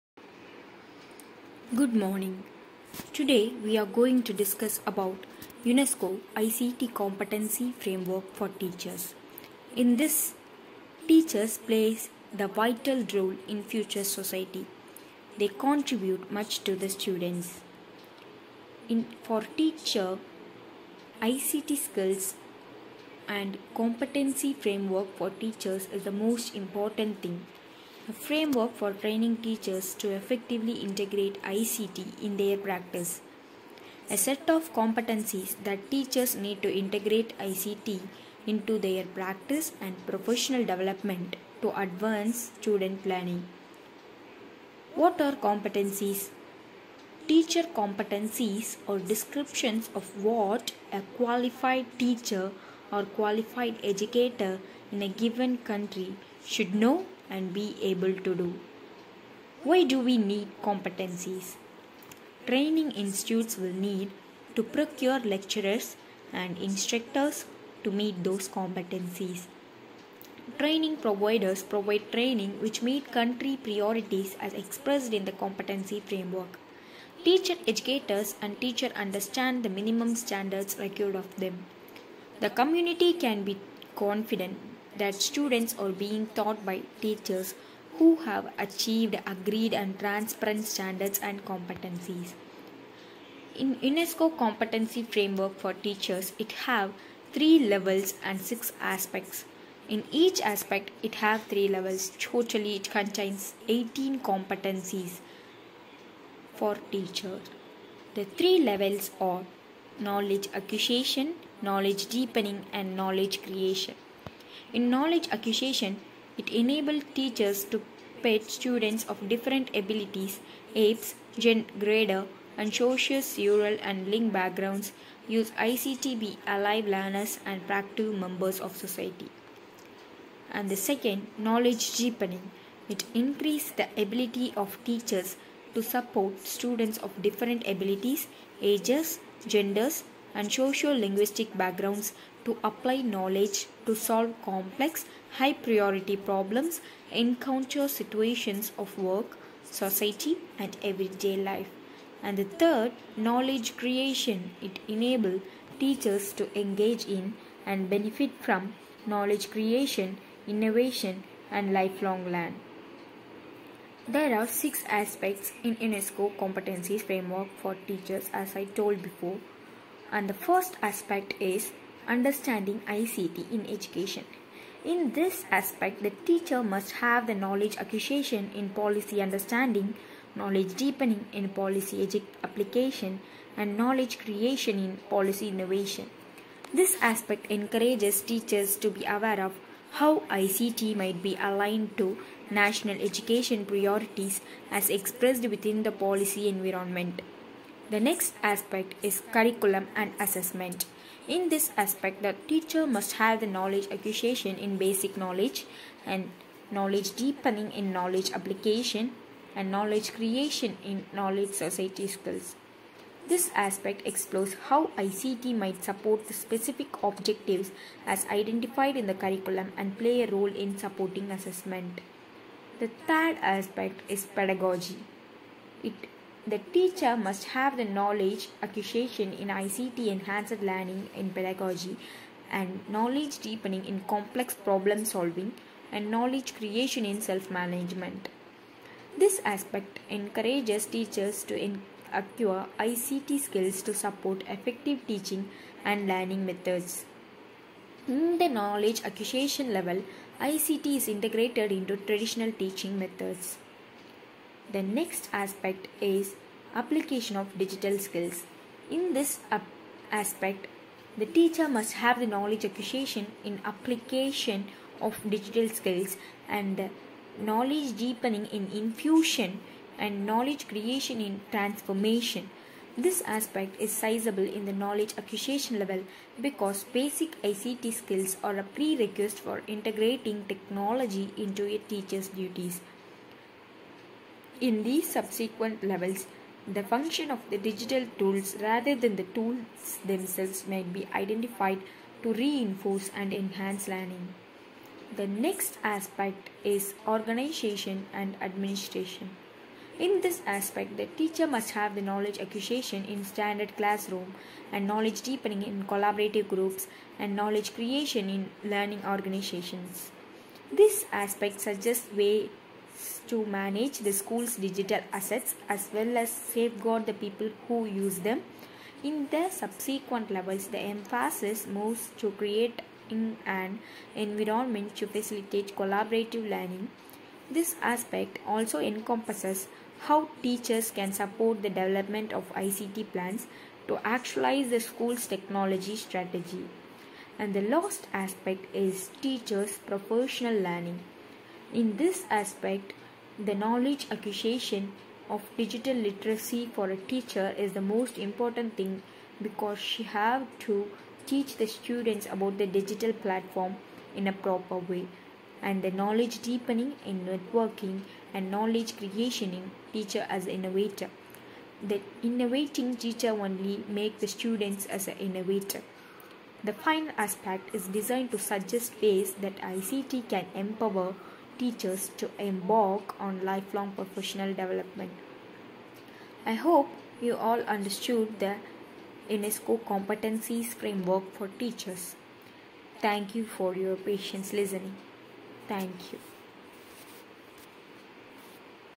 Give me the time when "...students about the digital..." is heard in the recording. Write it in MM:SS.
05:51.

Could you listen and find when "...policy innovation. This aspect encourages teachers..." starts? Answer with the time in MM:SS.
03:05.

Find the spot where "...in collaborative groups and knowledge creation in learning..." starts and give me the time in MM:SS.
05:05.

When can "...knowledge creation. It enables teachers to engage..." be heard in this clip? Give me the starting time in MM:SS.
02:33.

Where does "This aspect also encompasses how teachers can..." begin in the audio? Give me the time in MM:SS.
05:27.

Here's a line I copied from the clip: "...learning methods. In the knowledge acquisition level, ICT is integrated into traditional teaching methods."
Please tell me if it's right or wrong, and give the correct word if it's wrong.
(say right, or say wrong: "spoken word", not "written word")
right.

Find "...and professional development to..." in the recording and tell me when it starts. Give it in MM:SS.
00:39.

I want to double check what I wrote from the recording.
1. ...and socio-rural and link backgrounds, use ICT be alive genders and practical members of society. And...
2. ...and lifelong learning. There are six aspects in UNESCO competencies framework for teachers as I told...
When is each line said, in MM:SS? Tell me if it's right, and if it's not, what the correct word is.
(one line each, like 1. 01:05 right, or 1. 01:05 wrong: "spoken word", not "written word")
1. 02:02 wrong: "learners", not "genders"
2. 02:41 right.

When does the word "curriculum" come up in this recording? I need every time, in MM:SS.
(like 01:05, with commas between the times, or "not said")
03:19, 03:39.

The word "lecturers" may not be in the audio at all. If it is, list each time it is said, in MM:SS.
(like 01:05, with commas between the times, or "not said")
01:05.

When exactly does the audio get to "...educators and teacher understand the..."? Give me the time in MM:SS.
01:17.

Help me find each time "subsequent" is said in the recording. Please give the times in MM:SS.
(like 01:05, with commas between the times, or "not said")
04:45, 05:19.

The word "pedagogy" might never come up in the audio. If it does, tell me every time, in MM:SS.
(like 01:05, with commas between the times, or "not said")
03:44, 03:51.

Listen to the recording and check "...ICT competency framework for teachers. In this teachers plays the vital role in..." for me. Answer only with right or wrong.
right.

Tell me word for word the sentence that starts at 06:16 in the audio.
I hope you all understood the UNESCO competencies framework for teachers.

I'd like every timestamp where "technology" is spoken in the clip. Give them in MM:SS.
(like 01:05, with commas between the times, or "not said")
04:40, 05:35.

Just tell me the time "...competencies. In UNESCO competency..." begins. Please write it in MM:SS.
01:31.